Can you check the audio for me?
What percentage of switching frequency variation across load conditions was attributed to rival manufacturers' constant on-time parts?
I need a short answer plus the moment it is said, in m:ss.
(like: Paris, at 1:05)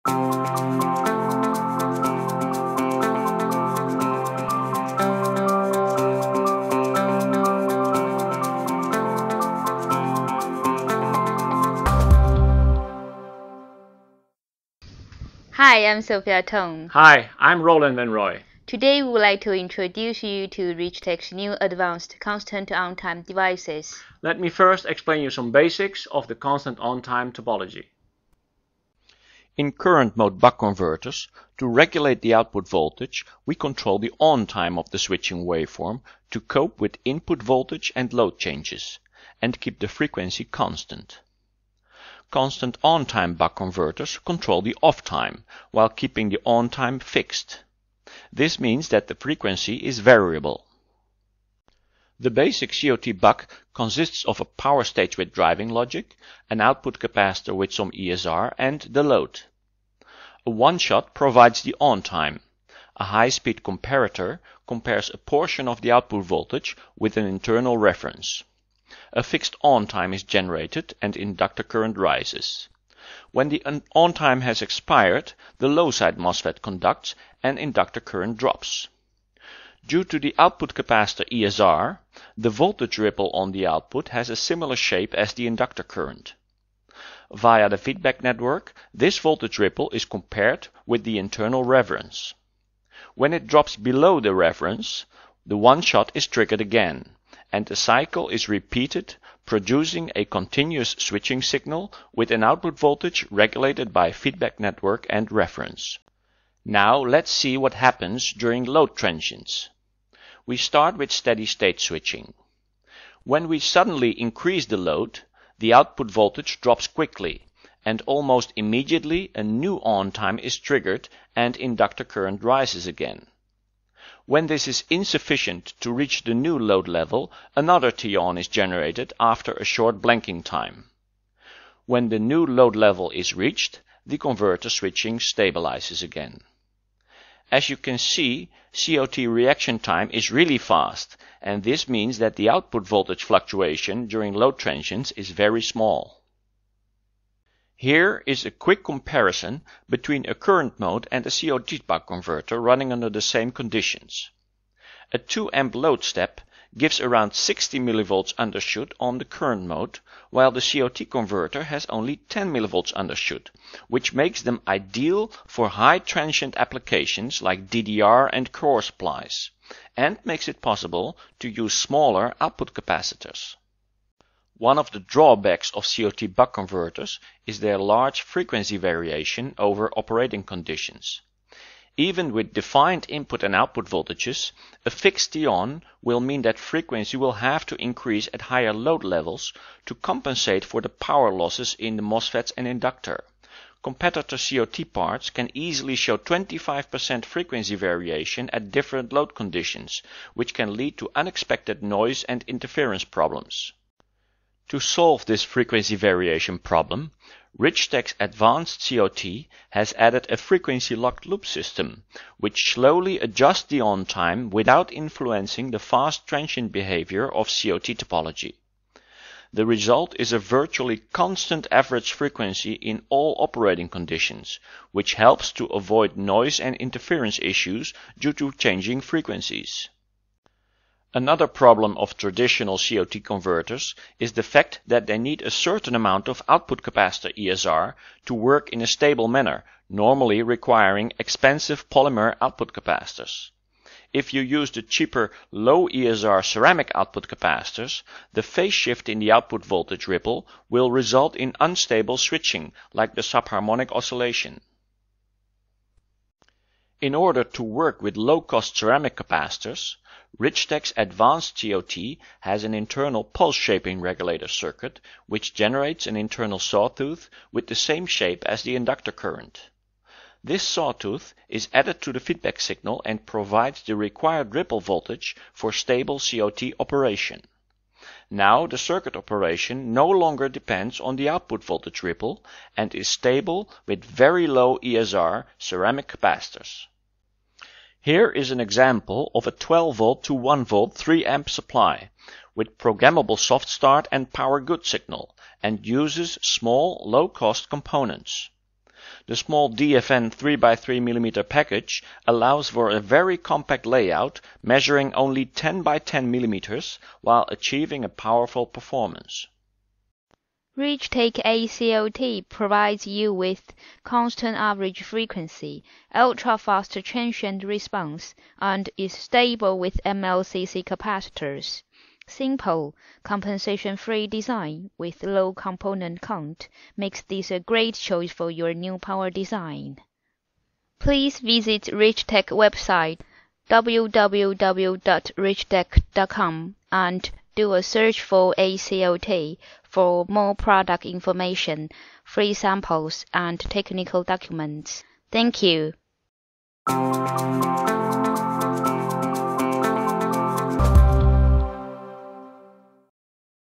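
25%, at 3:16.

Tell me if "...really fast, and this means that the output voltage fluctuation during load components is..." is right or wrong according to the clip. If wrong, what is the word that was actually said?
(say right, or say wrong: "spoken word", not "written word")
wrong: "transients", not "components".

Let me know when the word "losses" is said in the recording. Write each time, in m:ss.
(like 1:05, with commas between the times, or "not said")
3:11.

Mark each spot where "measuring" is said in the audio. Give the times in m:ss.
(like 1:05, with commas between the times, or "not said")
5:04.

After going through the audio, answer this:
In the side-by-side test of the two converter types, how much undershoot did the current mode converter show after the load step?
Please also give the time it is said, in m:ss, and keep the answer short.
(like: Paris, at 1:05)
60 mV, at 2:37.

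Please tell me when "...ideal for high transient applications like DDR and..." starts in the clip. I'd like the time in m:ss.
2:44.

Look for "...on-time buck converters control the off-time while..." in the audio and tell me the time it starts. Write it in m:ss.
0:42.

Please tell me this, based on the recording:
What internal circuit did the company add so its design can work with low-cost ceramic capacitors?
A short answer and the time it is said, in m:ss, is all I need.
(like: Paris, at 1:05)
pulse shaping regulator, at 4:23.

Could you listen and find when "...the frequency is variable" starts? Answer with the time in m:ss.
0:49.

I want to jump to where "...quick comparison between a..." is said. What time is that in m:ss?
2:28.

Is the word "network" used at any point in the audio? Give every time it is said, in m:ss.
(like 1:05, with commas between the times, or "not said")
1:28, 1:44.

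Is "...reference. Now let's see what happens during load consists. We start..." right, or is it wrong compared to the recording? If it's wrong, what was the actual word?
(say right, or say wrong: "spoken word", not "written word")
wrong: "transients", not "consists".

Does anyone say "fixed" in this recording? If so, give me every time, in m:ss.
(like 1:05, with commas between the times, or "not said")
0:46, 1:09, 3:04.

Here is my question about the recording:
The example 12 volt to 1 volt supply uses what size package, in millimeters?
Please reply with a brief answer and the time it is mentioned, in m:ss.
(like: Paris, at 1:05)
3x3 mm, at 5:00.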